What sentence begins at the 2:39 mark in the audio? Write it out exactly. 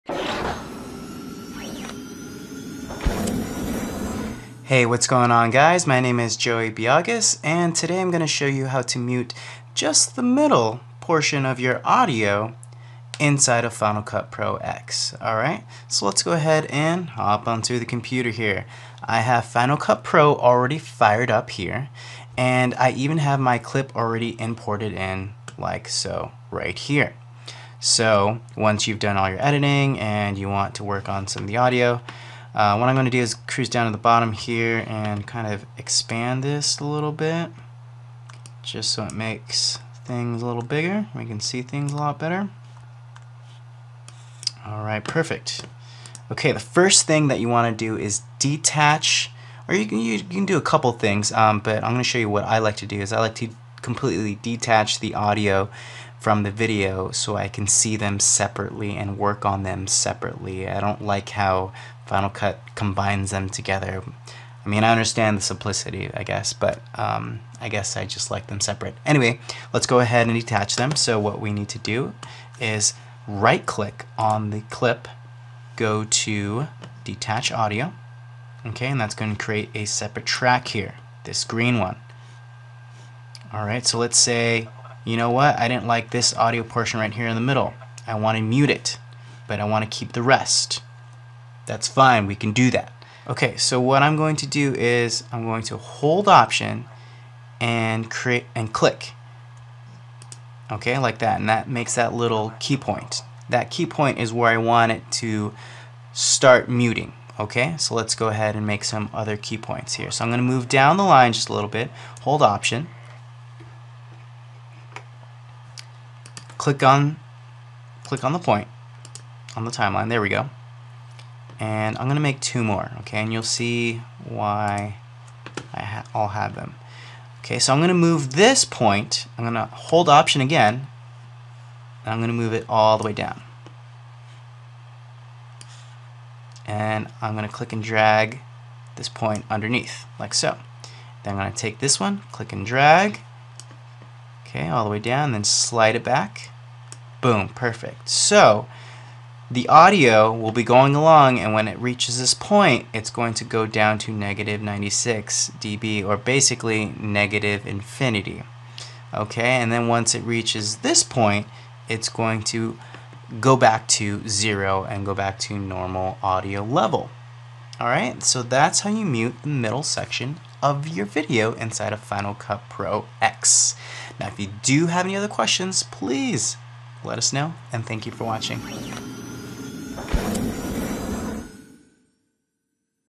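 Okay, and then once it reaches this point, it's going to go back to zero and go back to normal audio level.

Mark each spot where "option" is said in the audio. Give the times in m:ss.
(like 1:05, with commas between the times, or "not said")
1:36, 1:52, 2:10.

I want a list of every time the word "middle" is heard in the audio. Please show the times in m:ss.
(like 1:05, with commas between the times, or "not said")
0:10, 1:27, 2:49.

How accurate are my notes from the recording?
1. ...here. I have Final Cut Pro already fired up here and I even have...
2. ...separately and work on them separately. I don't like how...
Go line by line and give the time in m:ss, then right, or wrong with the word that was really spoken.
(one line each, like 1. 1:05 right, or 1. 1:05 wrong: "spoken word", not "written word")
1. 0:18 right
2. 0:58 right.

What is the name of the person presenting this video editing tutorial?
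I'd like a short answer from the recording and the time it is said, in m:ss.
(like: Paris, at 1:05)
Joey Biagas, at 0:06.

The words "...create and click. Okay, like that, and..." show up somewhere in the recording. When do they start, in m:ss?
1:38.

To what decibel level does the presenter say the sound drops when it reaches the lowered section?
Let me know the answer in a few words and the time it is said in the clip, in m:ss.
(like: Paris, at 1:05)
-96 dB, at 2:34.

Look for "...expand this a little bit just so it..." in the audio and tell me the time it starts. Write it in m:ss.
0:35.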